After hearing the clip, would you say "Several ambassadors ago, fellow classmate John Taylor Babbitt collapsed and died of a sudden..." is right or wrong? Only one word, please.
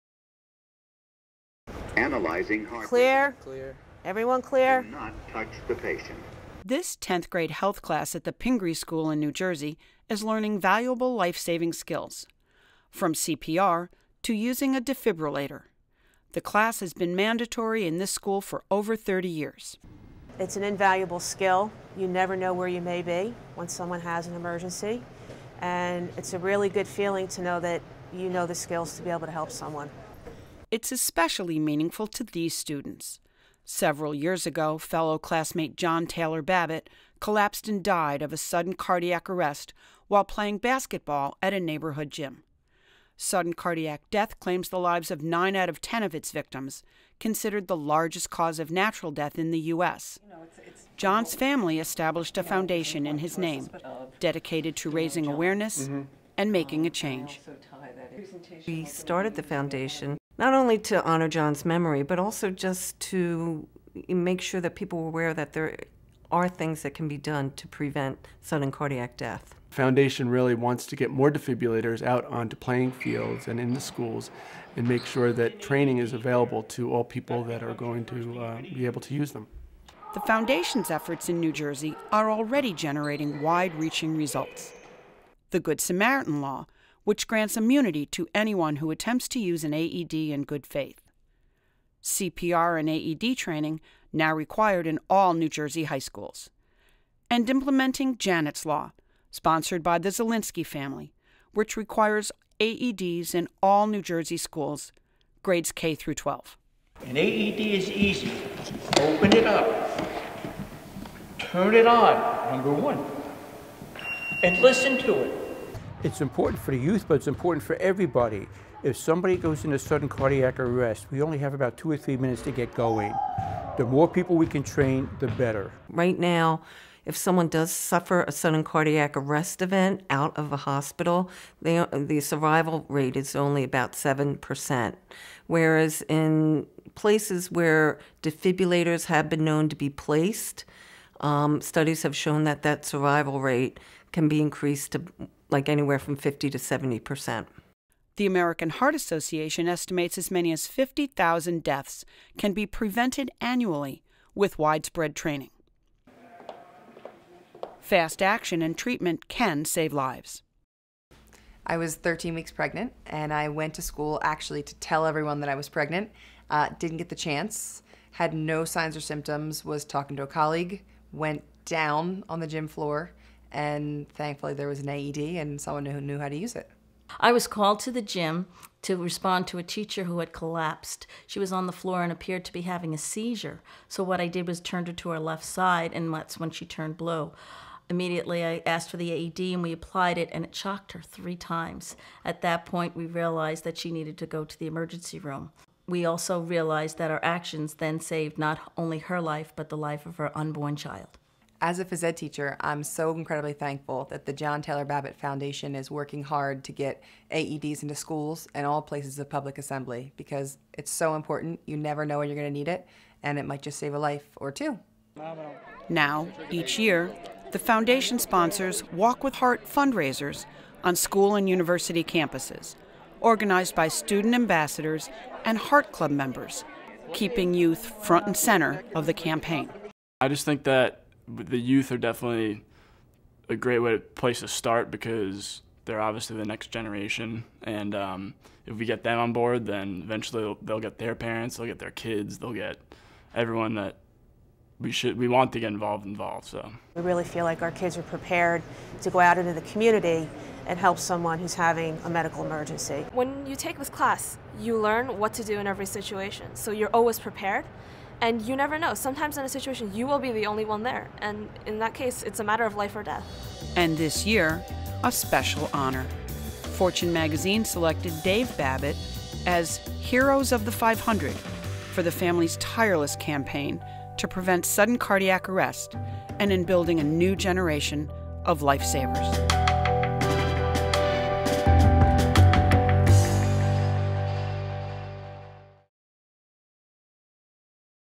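wrong.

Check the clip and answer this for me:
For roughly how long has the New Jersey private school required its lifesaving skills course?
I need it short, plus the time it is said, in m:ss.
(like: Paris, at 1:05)
Over 30 years, at 0:18.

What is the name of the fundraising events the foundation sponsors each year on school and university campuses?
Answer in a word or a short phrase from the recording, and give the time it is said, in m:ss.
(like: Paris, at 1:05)
Walk with Heart, at 3:38.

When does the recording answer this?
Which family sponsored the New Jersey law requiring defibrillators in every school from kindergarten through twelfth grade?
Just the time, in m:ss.
1:40.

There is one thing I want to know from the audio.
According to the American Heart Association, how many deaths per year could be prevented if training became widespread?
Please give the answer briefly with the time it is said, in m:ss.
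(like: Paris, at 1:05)
50,000, at 2:30.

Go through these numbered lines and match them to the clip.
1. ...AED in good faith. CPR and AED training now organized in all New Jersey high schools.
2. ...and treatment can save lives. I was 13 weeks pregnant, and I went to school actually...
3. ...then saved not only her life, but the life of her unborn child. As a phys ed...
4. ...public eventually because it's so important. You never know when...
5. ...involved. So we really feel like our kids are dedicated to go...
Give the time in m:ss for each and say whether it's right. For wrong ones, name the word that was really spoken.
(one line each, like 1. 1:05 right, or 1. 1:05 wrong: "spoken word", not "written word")
1. 1:29 wrong: "required", not "organized"
2. 2:38 right
3. 3:17 right
4. 3:29 wrong: "assembly", not "eventually"
5. 4:06 wrong: "prepared", not "dedicated".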